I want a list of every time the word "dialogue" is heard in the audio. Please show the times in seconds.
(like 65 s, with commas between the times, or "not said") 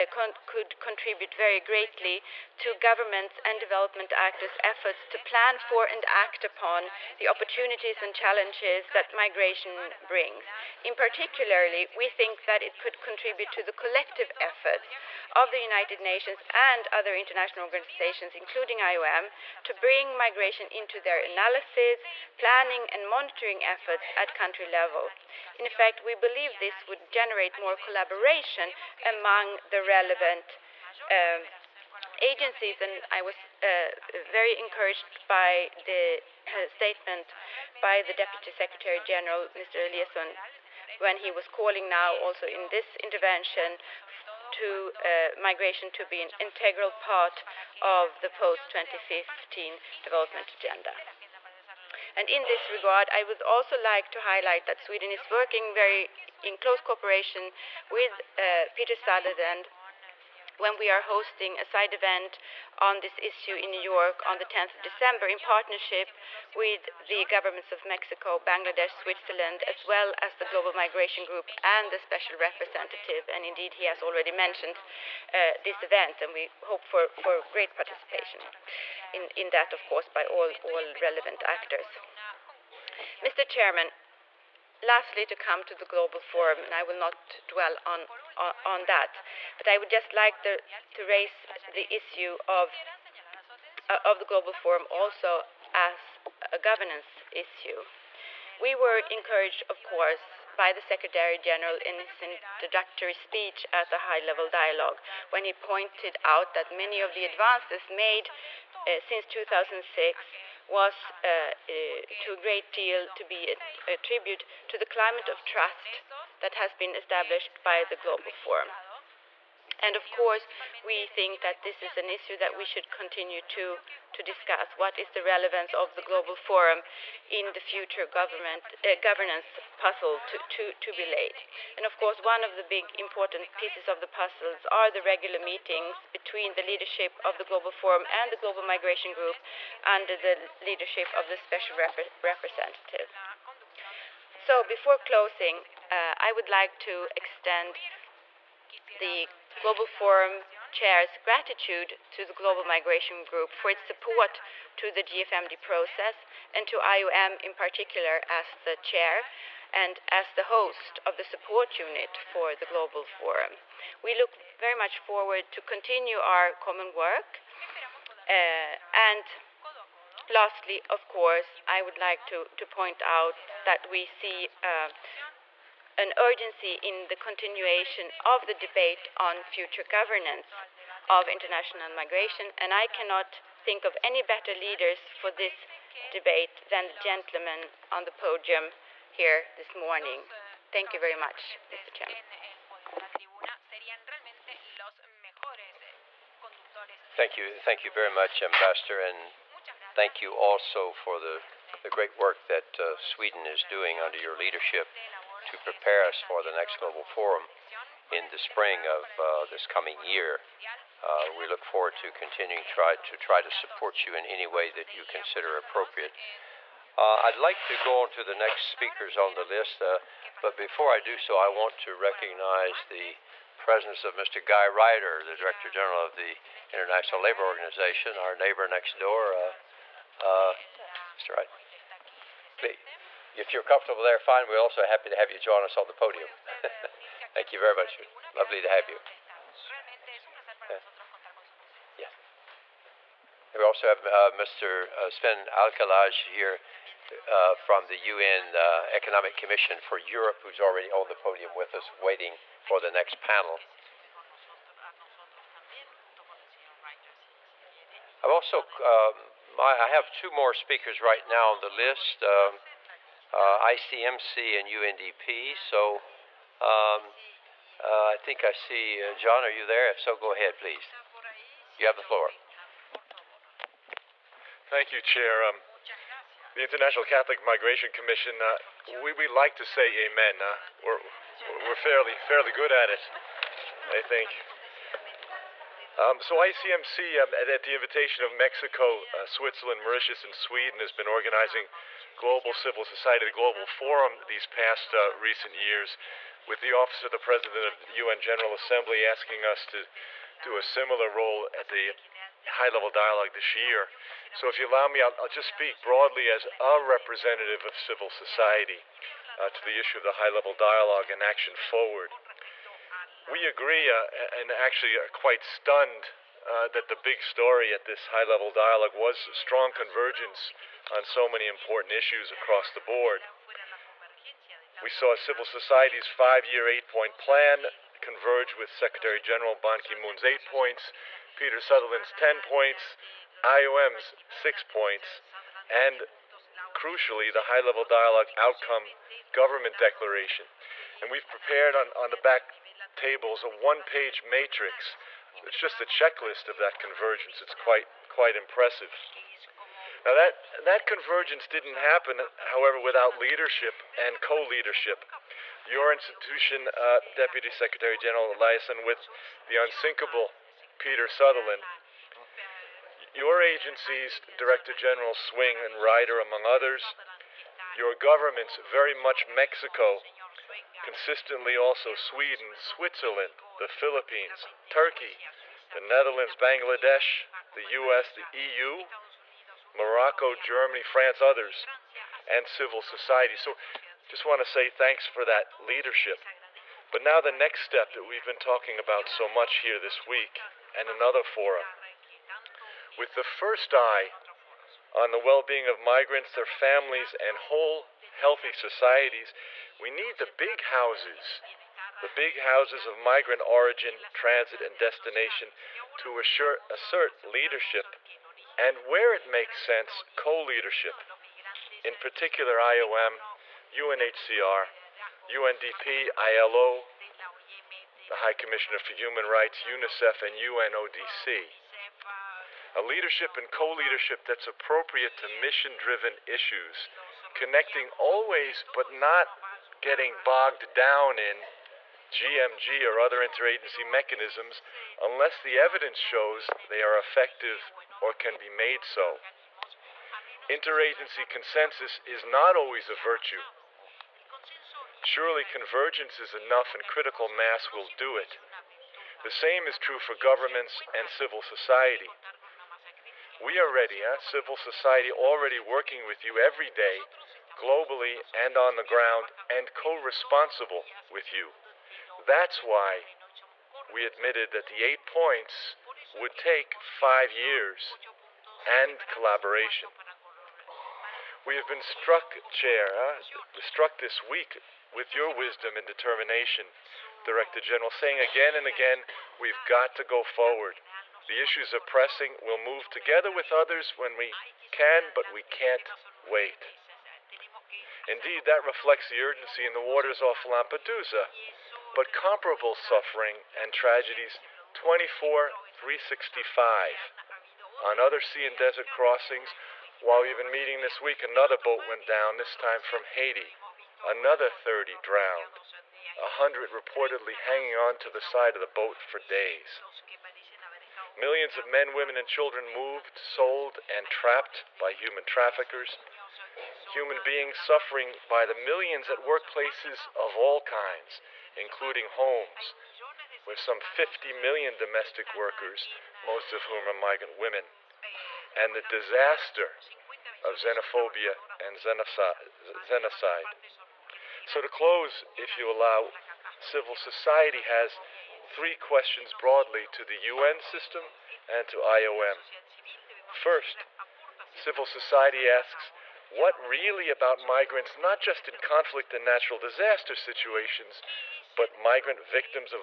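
104 s, 302 s, 310 s, 318 s, 337 s.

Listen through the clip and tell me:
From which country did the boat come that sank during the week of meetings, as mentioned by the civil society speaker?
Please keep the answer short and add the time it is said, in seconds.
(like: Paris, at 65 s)
Haiti, at 503 s.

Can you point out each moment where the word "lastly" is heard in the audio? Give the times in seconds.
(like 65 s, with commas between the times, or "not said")
84 s, 170 s.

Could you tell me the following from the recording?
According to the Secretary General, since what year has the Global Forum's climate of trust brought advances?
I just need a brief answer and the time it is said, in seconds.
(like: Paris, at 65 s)
2006, at 109 s.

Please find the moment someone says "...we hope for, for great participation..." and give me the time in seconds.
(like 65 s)
76 s.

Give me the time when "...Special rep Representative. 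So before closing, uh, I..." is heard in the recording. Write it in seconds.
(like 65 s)
141 s.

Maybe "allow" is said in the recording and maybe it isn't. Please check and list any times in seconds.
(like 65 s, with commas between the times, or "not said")
304 s, 535 s.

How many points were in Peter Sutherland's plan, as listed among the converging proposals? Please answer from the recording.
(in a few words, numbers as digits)
10.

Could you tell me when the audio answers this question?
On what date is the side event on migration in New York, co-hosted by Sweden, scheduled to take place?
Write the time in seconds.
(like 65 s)
64 s.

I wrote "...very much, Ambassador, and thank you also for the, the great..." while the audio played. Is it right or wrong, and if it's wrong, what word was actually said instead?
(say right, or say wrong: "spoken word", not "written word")
right.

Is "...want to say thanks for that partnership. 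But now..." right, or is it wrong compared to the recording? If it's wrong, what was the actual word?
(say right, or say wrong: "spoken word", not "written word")
wrong: "leadership", not "partnership".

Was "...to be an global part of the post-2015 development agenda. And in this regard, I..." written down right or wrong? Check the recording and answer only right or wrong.
wrong.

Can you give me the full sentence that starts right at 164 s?
We look very much forward to continue our common work.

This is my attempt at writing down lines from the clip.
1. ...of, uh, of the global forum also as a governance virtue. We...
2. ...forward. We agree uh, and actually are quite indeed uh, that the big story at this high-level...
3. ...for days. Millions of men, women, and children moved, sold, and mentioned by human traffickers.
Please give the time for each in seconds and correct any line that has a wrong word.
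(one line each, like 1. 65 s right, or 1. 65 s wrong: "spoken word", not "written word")
1. 92 s wrong: "issue", not "virtue"
2. 311 s wrong: "stunned", not "indeed"
3. 508 s wrong: "trapped", not "mentioned".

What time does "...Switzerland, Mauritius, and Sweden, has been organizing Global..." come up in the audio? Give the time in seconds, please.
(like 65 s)
289 s.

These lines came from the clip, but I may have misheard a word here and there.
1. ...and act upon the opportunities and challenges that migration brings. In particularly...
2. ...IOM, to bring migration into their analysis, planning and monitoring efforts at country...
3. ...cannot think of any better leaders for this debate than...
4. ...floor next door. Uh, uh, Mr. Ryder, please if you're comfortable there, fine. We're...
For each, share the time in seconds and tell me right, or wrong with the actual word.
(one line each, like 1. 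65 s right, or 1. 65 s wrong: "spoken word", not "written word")
1. 5 s right
2. 18 s right
3. 182 s right
4. 228 s wrong: "neighbor", not "floor".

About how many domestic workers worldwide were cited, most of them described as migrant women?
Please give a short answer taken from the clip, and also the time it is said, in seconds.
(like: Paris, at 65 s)
50 million, at 523 s.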